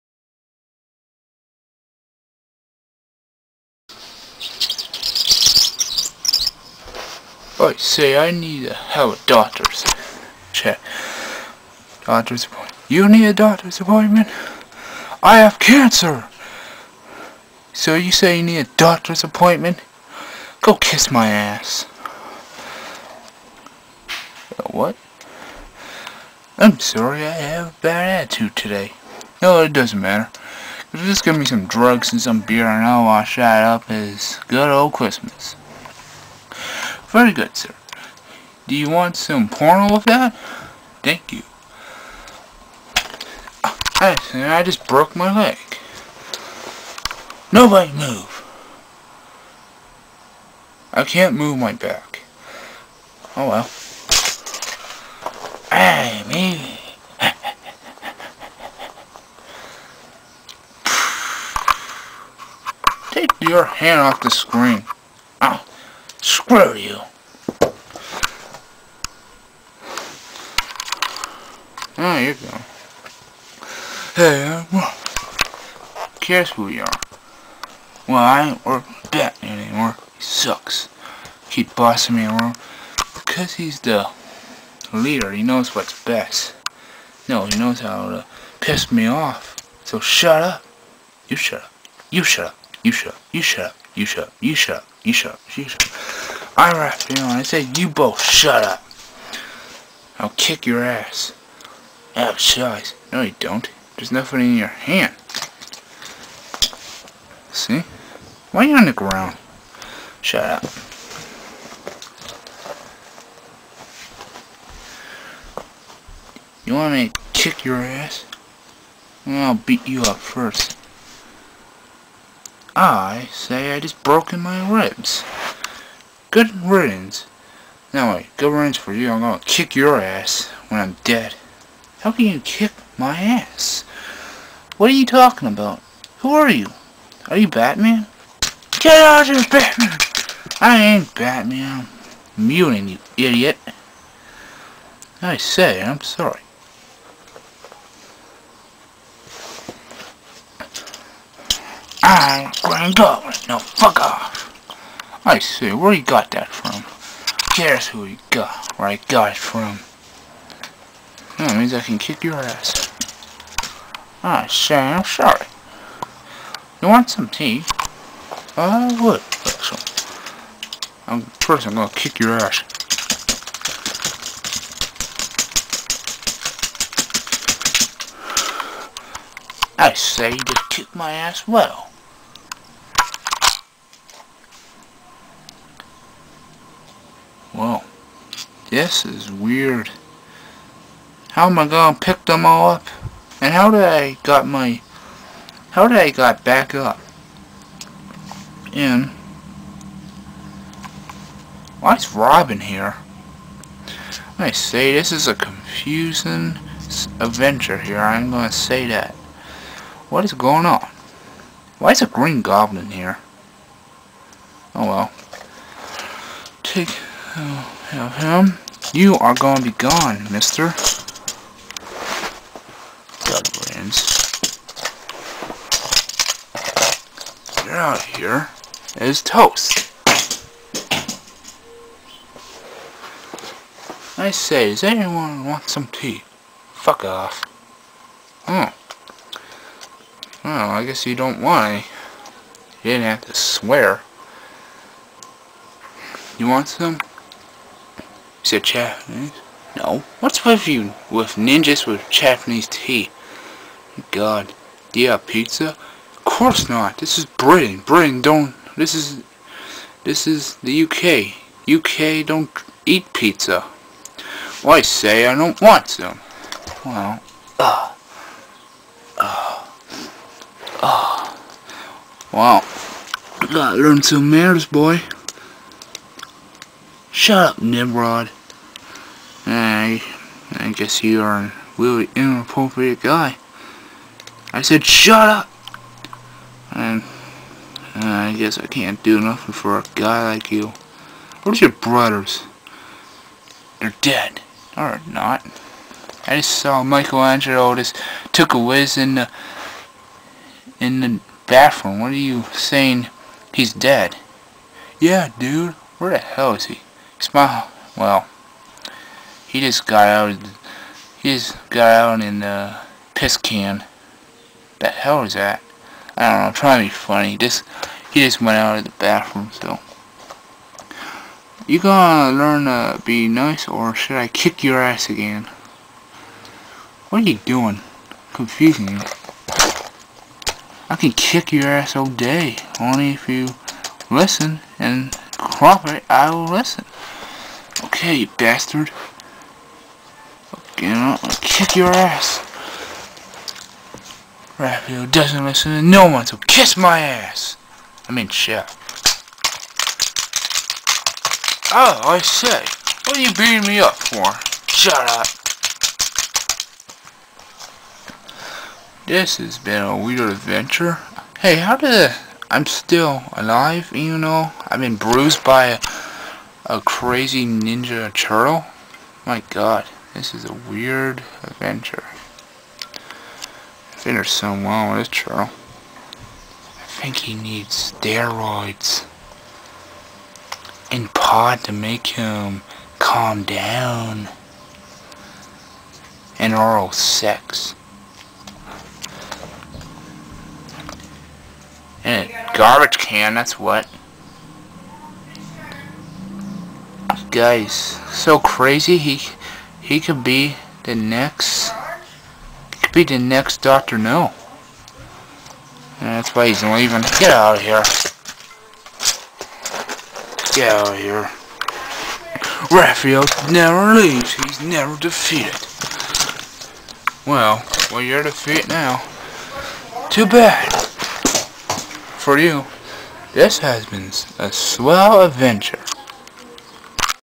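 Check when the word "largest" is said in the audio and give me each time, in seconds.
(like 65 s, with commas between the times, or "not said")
not said.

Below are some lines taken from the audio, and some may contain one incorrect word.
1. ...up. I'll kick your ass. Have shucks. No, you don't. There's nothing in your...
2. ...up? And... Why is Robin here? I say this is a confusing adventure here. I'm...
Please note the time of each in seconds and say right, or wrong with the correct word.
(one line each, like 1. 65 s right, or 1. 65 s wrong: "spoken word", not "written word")
1. 98 s right
2. 196 s right.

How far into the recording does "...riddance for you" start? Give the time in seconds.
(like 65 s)
128 s.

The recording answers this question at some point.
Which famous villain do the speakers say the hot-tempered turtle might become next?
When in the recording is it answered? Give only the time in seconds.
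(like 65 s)
403 s.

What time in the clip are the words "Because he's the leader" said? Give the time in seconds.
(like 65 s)
83 s.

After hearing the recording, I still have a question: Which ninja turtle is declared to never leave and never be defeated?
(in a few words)
Raphael.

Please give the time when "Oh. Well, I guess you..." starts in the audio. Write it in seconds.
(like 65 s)
238 s.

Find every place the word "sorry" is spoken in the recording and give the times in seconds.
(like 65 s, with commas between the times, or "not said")
26 s, 145 s, 165 s.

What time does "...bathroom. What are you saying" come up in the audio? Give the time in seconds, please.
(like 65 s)
301 s.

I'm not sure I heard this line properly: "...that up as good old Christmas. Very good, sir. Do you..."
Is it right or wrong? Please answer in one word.
right.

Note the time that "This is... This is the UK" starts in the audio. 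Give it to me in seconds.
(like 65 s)
258 s.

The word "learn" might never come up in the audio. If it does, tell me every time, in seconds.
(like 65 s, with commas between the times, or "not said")
273 s, 322 s.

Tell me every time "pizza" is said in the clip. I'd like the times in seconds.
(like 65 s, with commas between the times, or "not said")
255 s, 263 s.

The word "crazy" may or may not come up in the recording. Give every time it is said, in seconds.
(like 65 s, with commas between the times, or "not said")
366 s, 398 s.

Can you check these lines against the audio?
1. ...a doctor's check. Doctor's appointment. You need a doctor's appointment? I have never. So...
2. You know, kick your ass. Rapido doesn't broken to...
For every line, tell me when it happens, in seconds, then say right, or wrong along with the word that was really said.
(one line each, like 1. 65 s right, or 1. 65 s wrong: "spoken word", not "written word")
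1. 9 s wrong: "cancer", not "never"
2. 340 s wrong: "listen", not "broken".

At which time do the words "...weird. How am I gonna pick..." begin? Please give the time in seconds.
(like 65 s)
189 s.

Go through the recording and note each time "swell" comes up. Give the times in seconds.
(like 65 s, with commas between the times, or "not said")
424 s.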